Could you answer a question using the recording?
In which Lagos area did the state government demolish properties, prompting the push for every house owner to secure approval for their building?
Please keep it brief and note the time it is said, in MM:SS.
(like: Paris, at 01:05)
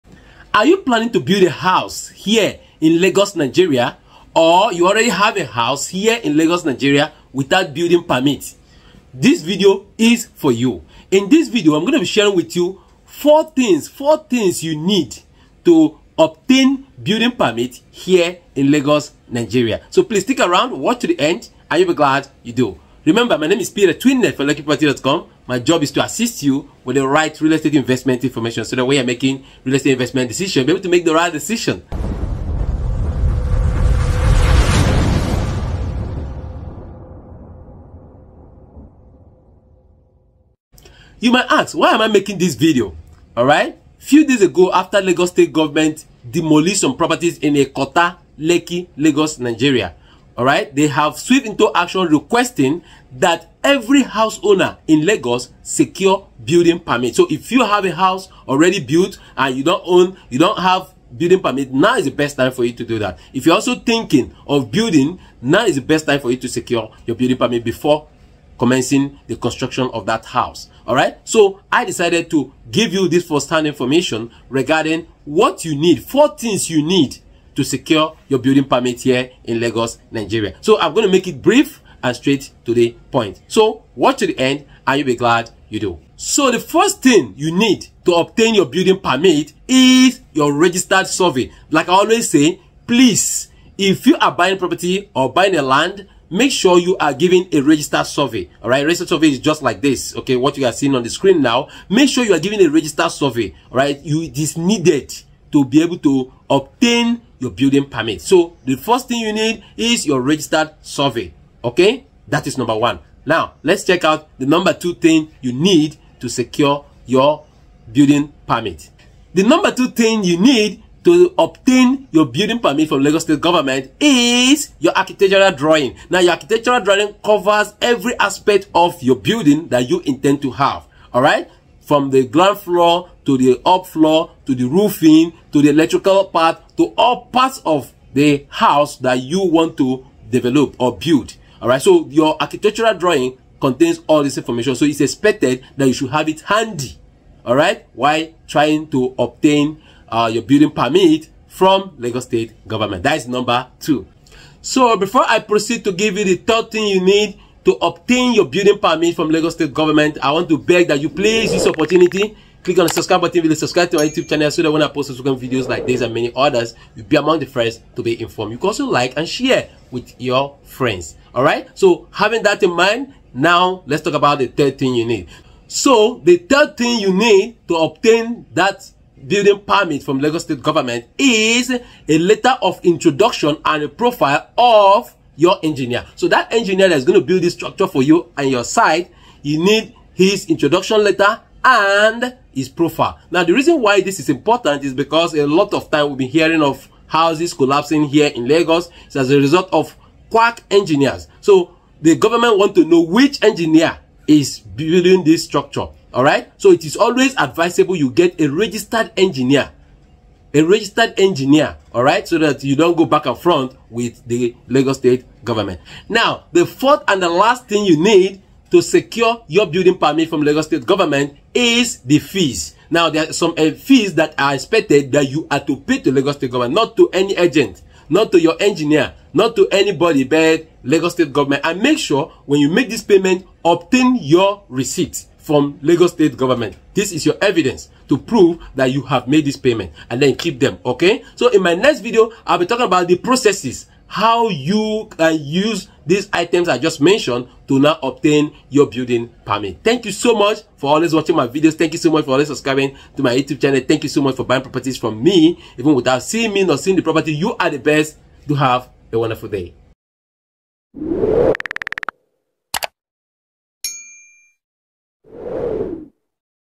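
Ikota, Lekki, at 00:47.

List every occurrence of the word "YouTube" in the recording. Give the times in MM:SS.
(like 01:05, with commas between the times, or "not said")
02:44, 04:13.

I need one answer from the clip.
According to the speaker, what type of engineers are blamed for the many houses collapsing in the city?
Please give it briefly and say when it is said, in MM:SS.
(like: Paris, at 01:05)
Quack engineers, at 03:20.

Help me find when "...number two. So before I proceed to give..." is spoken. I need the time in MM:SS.
02:33.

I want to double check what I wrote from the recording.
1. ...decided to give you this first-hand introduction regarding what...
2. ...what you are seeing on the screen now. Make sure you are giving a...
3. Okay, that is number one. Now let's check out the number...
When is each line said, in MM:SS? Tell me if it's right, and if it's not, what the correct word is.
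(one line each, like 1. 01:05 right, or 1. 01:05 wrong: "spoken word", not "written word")
1. 01:11 wrong: "information", not "introduction"
2. 01:40 right
3. 01:51 right.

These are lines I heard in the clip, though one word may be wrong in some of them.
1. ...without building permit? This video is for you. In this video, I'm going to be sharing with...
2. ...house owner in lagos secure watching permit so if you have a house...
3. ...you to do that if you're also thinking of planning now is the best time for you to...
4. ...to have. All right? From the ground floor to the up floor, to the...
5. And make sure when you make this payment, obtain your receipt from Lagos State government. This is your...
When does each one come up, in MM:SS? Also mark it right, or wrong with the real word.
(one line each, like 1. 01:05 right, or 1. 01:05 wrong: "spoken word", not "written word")
1. 00:07 right
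2. 00:54 wrong: "building", not "watching"
3. 01:02 wrong: "building", not "planning"
4. 02:10 right
5. 03:51 right.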